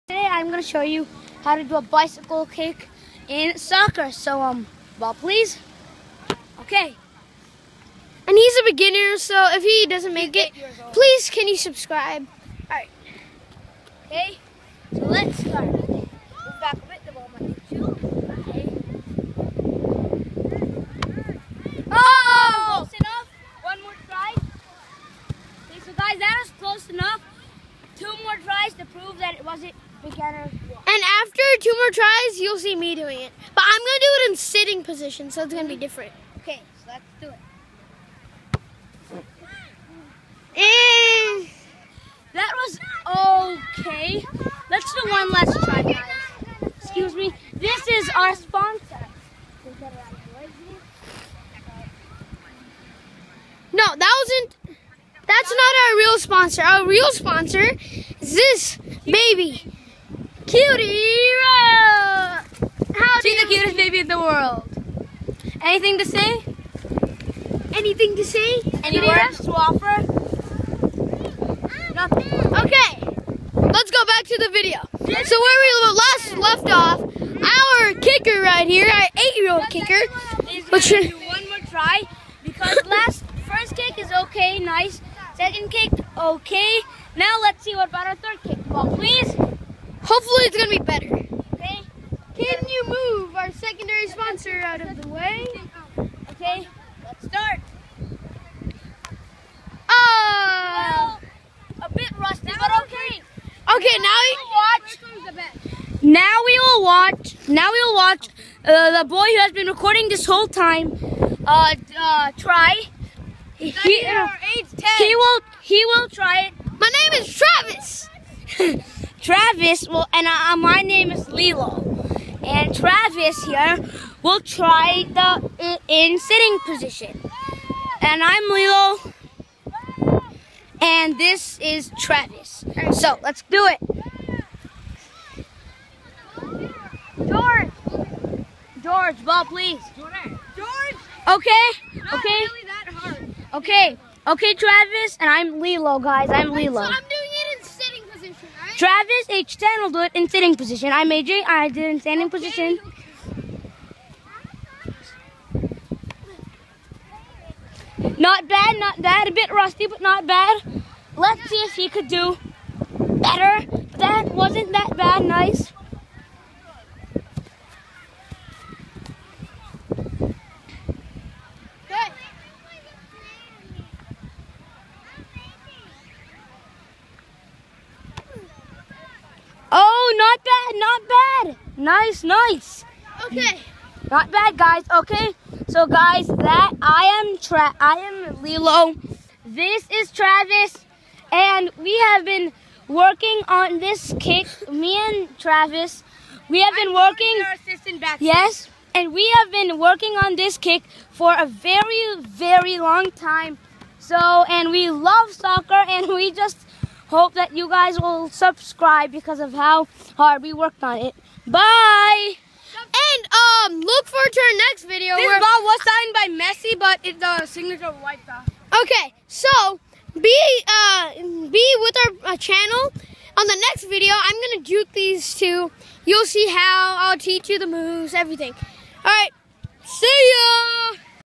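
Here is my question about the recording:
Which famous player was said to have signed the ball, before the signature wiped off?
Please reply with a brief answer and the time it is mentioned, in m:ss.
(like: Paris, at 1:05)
Messi, at 3:36.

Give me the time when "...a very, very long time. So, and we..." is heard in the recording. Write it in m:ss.
3:21.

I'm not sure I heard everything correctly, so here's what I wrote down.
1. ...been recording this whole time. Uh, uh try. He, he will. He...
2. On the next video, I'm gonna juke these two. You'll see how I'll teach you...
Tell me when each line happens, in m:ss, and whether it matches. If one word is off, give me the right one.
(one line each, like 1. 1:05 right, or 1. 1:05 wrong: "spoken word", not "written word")
1. 1:49 right
2. 3:43 right.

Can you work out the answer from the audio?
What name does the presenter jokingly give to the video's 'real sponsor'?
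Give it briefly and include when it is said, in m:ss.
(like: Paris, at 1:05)
Cutie, at 1:00.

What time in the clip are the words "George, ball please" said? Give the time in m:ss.
2:18.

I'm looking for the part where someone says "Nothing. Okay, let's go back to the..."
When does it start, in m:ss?
1:11.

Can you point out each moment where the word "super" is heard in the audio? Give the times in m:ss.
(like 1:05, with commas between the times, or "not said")
not said.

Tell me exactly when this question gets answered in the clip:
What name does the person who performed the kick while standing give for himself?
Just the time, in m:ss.
2:31.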